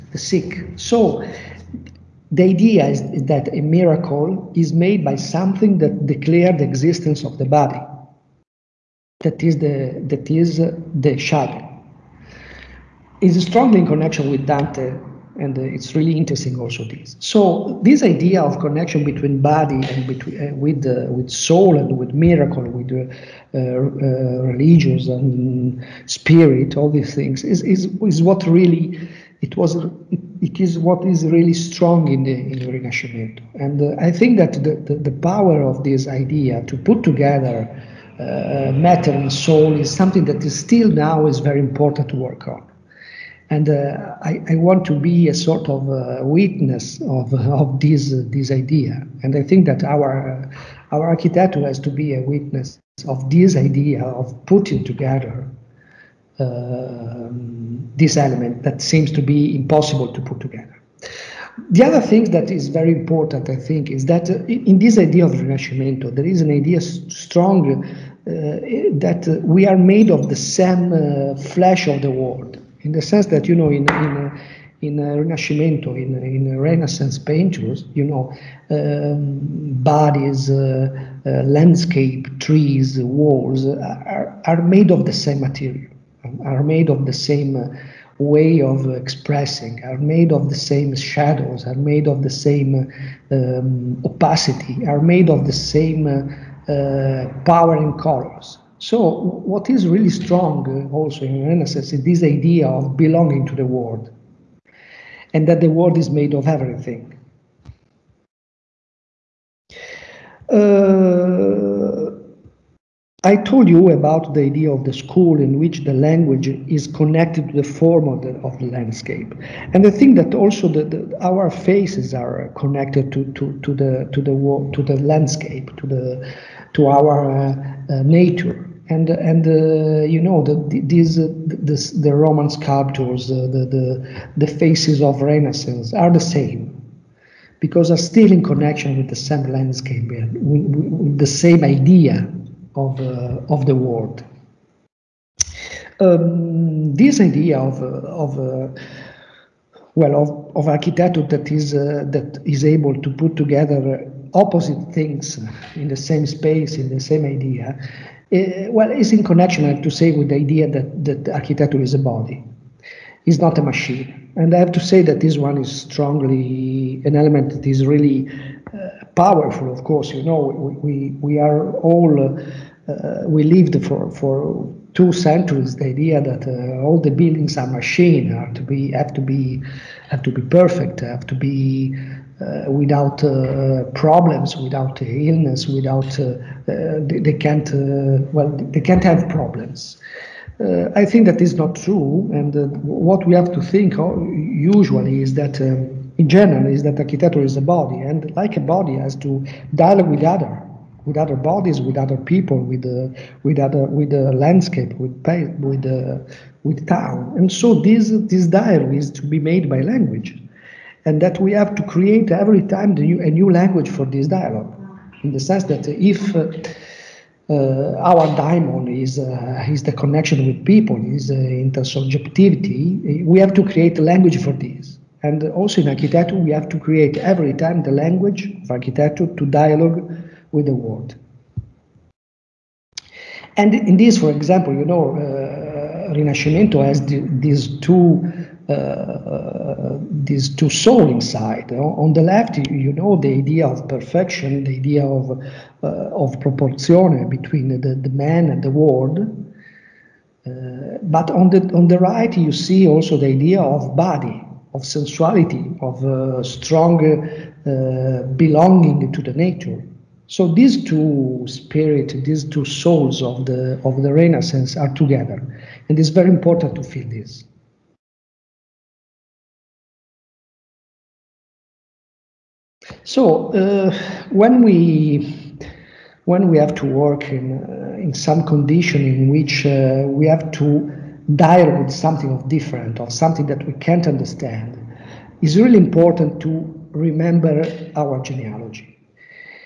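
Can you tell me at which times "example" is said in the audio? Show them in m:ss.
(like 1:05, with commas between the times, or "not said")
3:54.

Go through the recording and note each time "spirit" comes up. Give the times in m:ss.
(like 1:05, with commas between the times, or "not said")
0:26, 4:21.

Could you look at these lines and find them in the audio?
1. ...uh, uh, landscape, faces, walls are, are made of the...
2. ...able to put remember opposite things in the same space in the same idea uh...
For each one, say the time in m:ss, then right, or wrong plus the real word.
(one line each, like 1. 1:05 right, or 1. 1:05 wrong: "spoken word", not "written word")
1. 1:20 wrong: "trees", not "faces"
2. 2:32 wrong: "together", not "remember".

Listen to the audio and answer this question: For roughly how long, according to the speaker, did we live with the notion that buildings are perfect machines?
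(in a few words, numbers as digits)
2 centuries.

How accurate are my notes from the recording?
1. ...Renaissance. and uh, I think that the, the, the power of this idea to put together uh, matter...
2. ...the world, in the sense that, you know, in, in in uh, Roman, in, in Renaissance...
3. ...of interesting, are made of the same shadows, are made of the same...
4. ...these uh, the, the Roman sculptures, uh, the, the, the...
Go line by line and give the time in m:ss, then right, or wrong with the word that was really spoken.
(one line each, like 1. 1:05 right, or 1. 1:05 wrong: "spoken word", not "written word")
1. 0:32 right
2. 1:12 wrong: "Rinascimento", not "Roman"
3. 1:28 wrong: "expressing", not "interesting"
4. 2:10 right.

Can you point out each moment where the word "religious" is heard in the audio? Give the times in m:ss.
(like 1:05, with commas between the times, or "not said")
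0:24.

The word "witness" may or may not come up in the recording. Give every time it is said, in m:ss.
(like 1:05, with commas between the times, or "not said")
0:46, 0:52.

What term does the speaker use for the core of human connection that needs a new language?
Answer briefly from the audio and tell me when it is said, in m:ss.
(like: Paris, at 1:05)
Intersubjectivity, at 3:41.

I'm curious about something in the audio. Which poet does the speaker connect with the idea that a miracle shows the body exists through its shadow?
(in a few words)
Dante.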